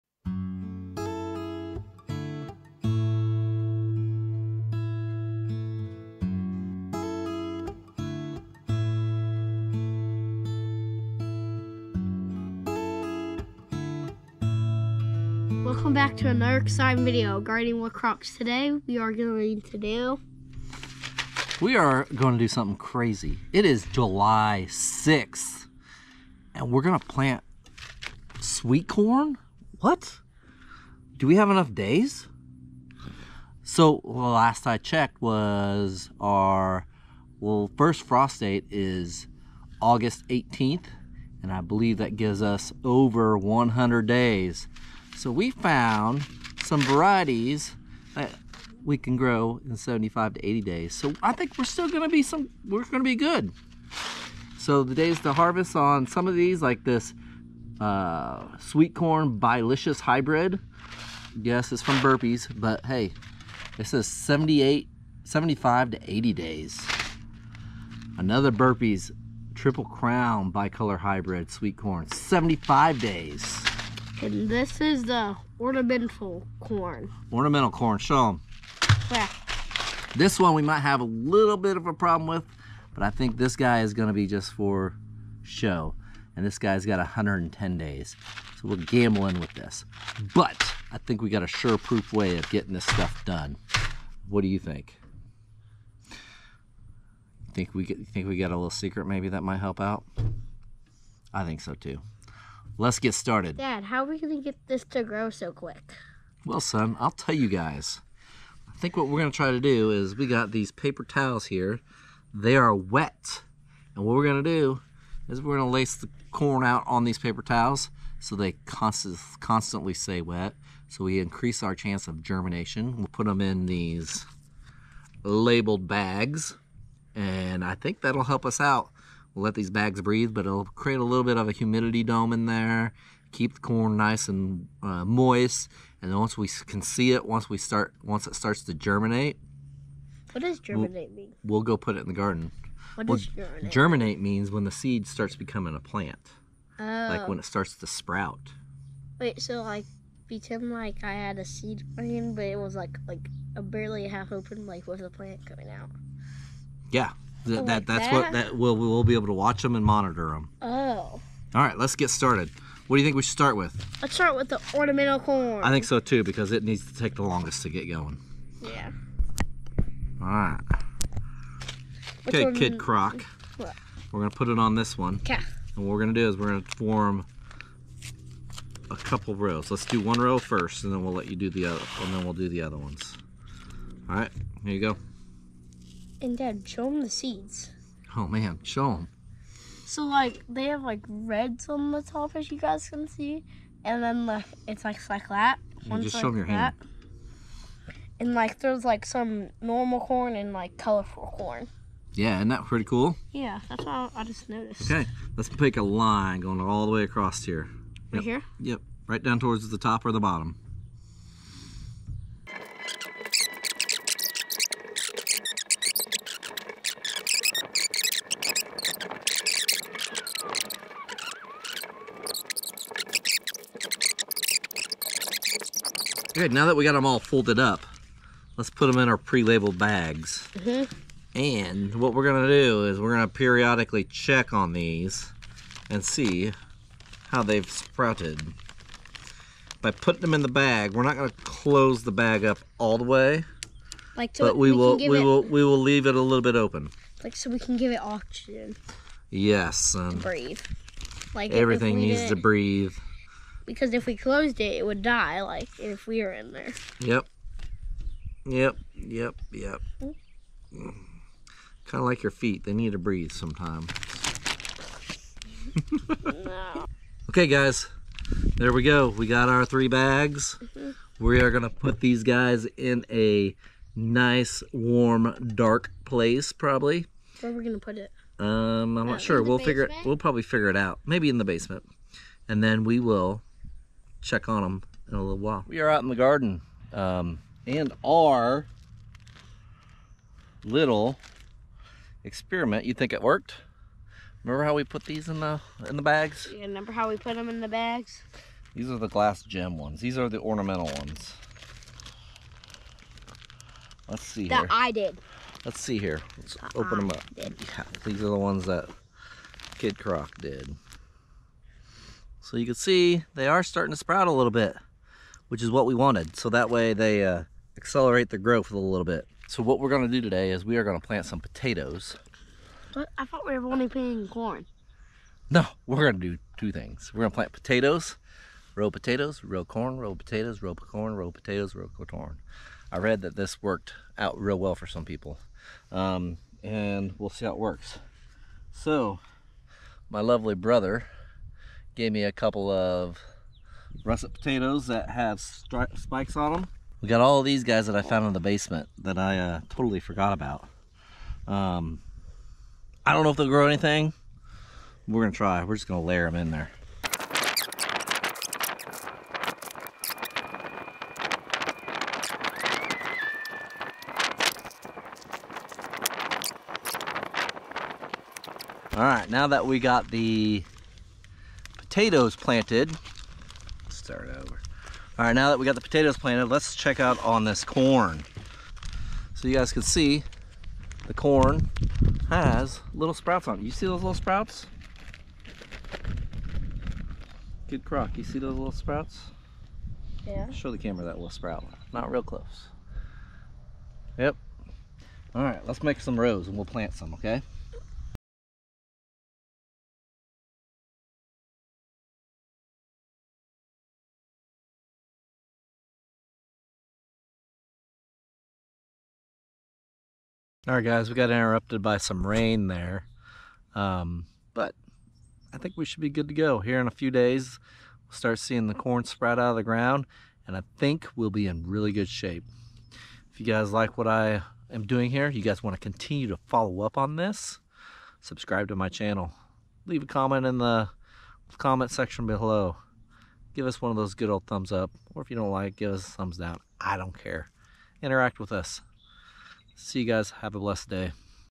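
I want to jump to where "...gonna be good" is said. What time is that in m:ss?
0:52.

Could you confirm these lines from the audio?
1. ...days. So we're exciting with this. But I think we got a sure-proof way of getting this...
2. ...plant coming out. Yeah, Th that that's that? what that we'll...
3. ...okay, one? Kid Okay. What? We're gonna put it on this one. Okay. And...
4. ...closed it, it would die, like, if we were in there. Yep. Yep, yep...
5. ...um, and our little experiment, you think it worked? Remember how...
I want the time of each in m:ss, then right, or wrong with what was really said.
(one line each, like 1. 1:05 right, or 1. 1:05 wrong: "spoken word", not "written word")
1. 1:27 wrong: "gambling", not "exciting"
2. 2:35 right
3. 2:52 wrong: "Croc", not "Okay"
4. 4:14 right
5. 4:46 right.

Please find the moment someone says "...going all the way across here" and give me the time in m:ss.
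3:26.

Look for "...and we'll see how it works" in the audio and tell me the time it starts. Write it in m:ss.
5:36.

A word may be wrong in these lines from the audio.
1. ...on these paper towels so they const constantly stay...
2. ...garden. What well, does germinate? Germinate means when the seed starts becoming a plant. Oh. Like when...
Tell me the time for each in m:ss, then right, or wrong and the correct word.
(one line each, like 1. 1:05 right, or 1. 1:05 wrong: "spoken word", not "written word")
1. 1:56 right
2. 2:22 right.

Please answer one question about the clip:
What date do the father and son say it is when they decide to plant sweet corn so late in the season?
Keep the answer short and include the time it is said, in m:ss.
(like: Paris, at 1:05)
July 6th, at 0:23.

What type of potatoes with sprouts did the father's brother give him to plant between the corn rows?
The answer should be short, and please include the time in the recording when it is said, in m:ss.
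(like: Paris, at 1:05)
russet, at 5:44.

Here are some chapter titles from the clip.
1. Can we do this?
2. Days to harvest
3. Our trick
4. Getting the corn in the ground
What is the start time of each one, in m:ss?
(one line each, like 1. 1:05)
1. 0:25
2. 0:56
3. 1:44
4. 4:48.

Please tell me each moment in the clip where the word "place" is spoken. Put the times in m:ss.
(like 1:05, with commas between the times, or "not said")
4:36.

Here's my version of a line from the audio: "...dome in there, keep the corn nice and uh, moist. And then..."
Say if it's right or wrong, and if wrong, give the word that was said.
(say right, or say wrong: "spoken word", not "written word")
right.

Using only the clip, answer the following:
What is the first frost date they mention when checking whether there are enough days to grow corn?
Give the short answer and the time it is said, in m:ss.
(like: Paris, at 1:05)
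August 18th, at 0:39.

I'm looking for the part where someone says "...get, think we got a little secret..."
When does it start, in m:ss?
1:37.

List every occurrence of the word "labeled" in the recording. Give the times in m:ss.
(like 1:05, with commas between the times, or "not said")
2:05, 3:49.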